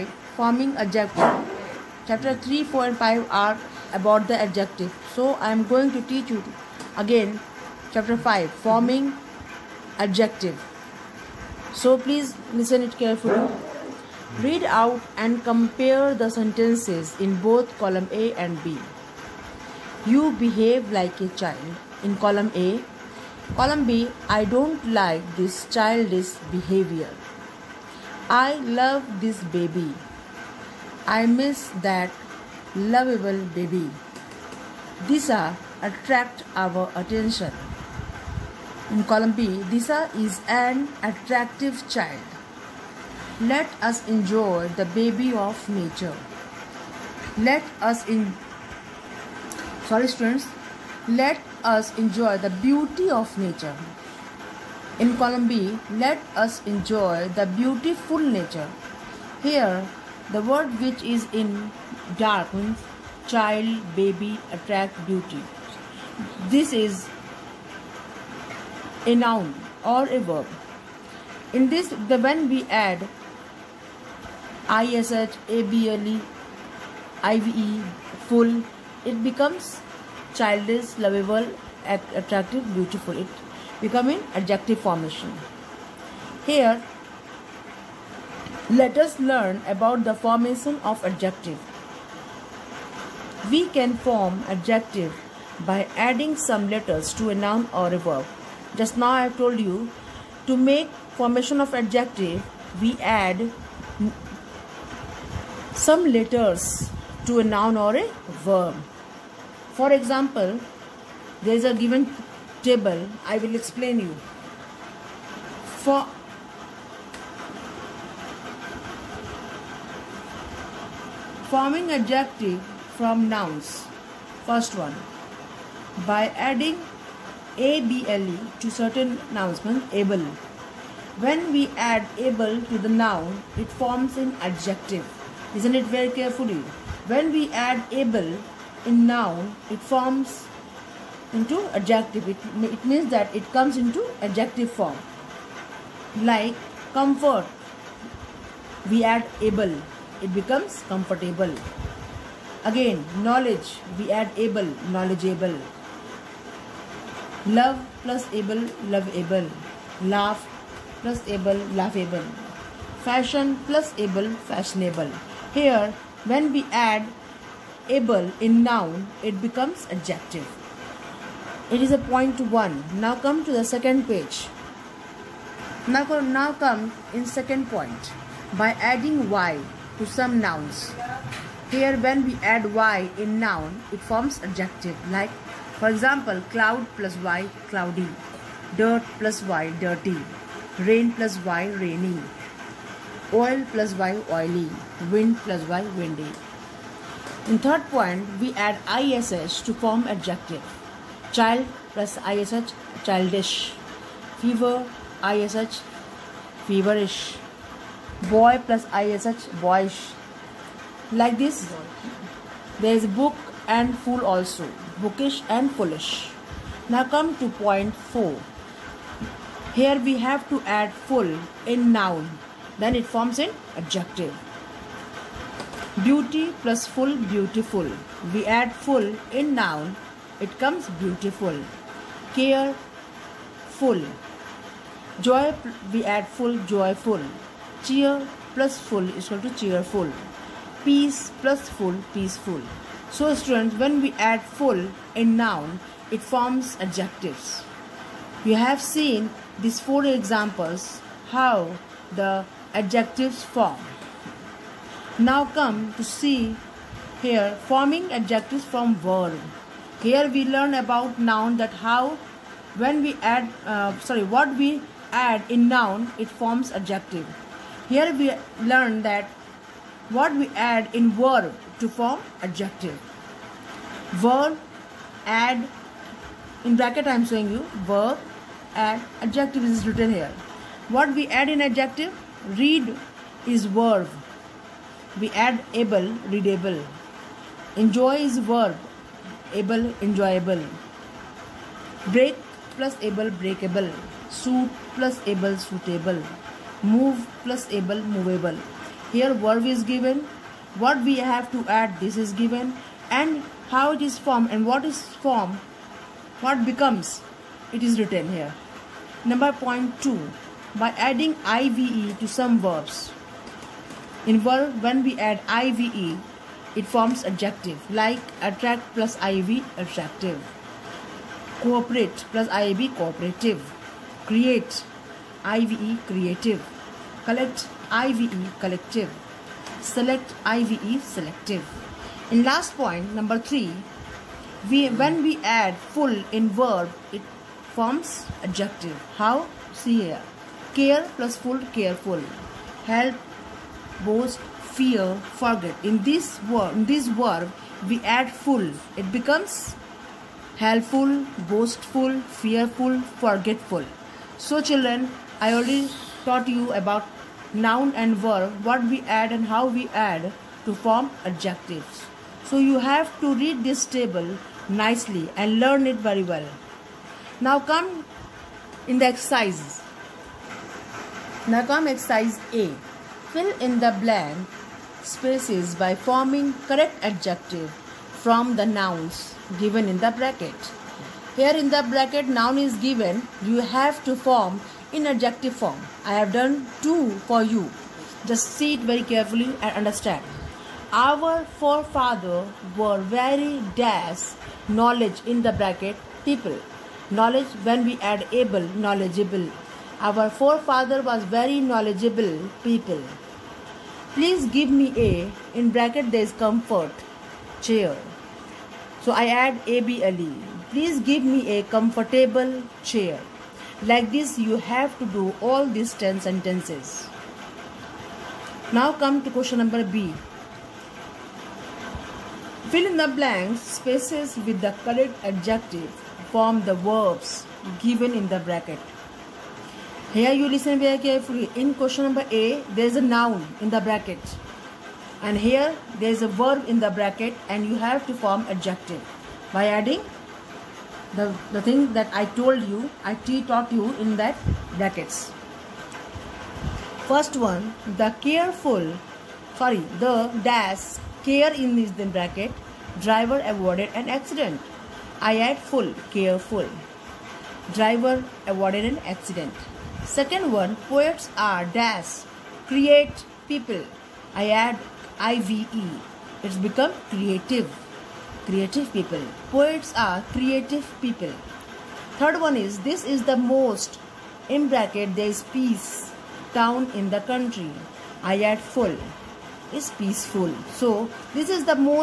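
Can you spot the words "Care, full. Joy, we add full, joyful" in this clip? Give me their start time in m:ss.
3:52.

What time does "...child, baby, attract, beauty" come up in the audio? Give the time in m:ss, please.
1:03.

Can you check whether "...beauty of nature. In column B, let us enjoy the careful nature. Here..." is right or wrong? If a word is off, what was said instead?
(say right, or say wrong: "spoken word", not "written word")
wrong: "beautiful", not "careful".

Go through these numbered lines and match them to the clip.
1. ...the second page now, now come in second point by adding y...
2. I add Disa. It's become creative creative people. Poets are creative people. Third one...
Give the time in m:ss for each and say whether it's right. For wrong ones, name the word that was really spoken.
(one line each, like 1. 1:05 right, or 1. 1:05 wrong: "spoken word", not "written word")
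1. 2:53 right
2. 7:44 wrong: "IVE", not "Disa".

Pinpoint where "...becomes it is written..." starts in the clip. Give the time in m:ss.
5:06.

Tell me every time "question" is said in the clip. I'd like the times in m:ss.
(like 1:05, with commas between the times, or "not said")
6:59, 7:11.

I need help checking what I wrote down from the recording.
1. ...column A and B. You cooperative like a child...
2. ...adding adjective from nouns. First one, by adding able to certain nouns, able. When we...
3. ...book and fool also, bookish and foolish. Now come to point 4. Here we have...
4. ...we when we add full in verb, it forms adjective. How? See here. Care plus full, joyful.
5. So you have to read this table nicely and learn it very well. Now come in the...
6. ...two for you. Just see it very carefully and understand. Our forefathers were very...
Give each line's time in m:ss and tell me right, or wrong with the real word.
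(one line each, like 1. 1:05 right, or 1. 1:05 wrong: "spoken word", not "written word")
1. 0:17 wrong: "behave", not "cooperative"
2. 2:01 wrong: "forming", not "adding"
3. 3:33 right
4. 5:34 wrong: "careful", not "joyful"
5. 6:02 right
6. 6:26 right.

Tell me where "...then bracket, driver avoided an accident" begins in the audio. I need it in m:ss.
7:31.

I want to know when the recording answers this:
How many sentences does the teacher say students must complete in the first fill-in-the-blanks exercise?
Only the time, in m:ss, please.
6:55.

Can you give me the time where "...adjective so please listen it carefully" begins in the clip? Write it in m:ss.
0:10.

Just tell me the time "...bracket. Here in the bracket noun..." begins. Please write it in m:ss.
6:20.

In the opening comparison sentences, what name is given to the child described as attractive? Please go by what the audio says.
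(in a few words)
Disa.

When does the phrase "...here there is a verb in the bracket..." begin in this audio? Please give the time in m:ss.
7:15.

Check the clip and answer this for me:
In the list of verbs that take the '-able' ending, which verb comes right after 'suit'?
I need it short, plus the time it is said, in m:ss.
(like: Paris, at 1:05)
move, at 4:56.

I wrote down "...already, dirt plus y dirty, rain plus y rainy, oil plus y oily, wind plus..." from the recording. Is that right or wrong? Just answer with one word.
wrong.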